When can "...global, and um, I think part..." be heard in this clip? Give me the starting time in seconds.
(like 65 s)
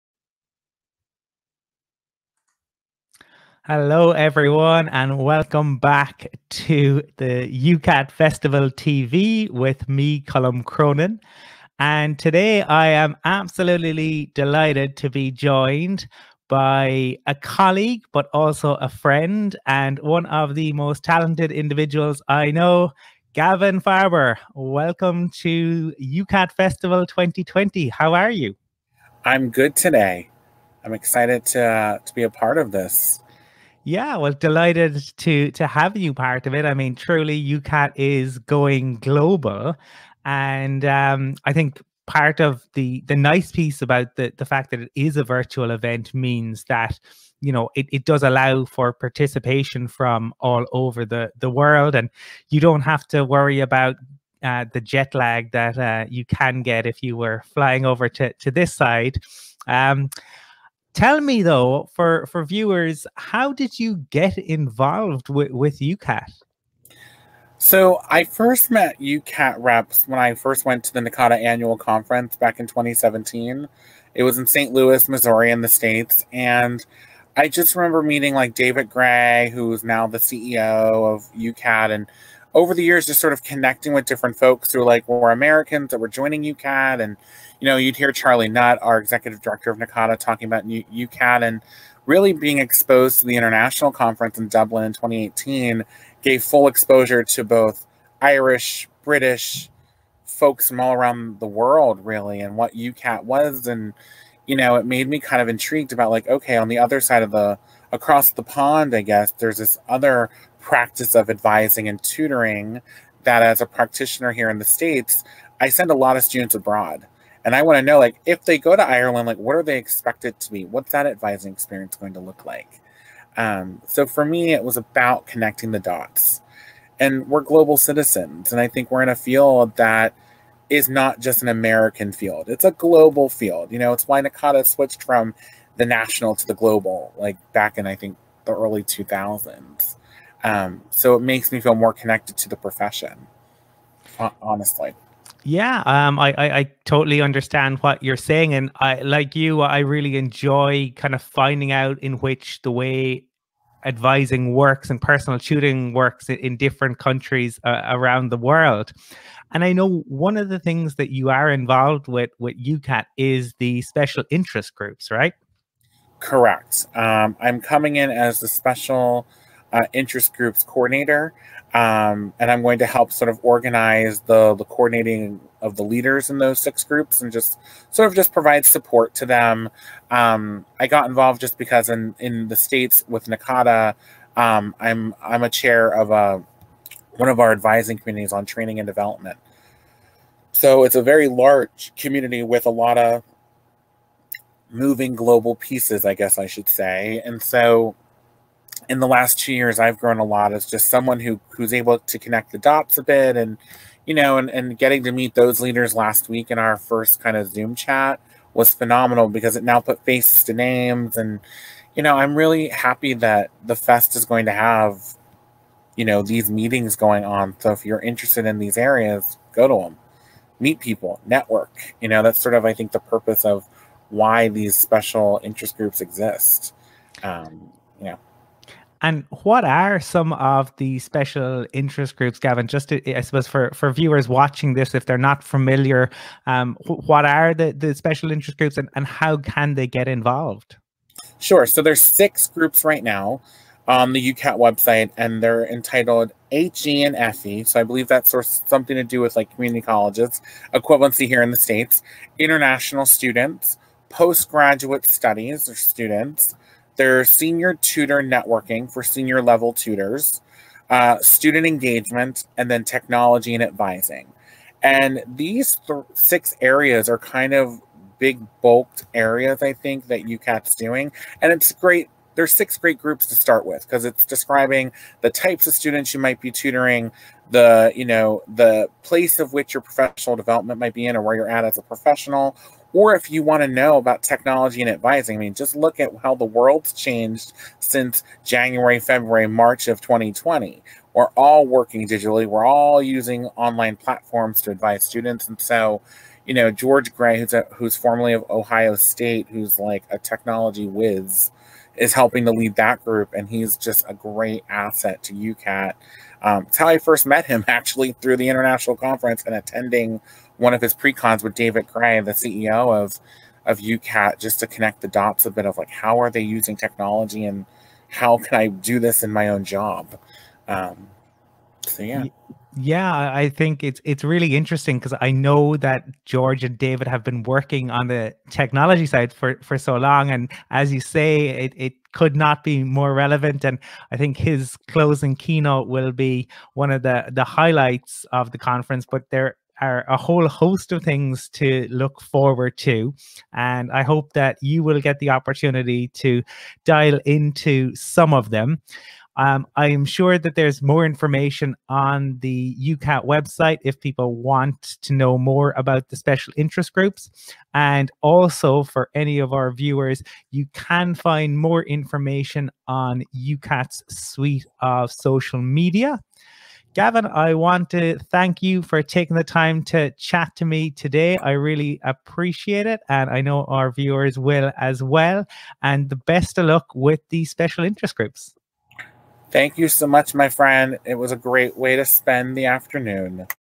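38 s.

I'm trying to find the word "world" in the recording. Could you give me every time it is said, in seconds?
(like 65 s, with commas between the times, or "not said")
51 s, 101 s, 158 s, 286 s.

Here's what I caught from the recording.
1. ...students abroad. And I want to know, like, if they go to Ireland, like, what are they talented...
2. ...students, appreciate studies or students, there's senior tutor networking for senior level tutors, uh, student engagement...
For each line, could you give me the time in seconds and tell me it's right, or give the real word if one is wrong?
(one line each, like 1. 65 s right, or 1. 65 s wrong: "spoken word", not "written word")
1. 116 s wrong: "expected", not "talented"
2. 253 s wrong: "postgraduate", not "appreciate".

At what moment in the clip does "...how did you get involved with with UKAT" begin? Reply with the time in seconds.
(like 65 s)
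63 s.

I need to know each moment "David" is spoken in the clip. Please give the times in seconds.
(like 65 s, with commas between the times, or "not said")
78 s, 311 s, 326 s.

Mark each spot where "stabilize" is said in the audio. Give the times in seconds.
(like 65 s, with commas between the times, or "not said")
not said.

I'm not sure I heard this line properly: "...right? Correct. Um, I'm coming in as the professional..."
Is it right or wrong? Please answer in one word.
wrong.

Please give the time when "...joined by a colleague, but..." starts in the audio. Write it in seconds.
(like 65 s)
15 s.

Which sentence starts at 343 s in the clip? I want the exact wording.
And I hope that you will get the opportunity to dial into some of them.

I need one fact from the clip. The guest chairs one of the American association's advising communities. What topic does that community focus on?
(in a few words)
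training and development.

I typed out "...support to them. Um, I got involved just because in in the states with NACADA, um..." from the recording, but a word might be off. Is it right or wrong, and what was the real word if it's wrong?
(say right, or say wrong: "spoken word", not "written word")
right.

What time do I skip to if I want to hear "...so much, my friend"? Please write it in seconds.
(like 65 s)
379 s.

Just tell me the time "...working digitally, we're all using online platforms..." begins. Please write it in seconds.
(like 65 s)
291 s.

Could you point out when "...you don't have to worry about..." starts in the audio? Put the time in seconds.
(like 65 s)
52 s.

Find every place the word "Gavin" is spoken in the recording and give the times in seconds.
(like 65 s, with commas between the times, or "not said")
23 s, 232 s, 366 s.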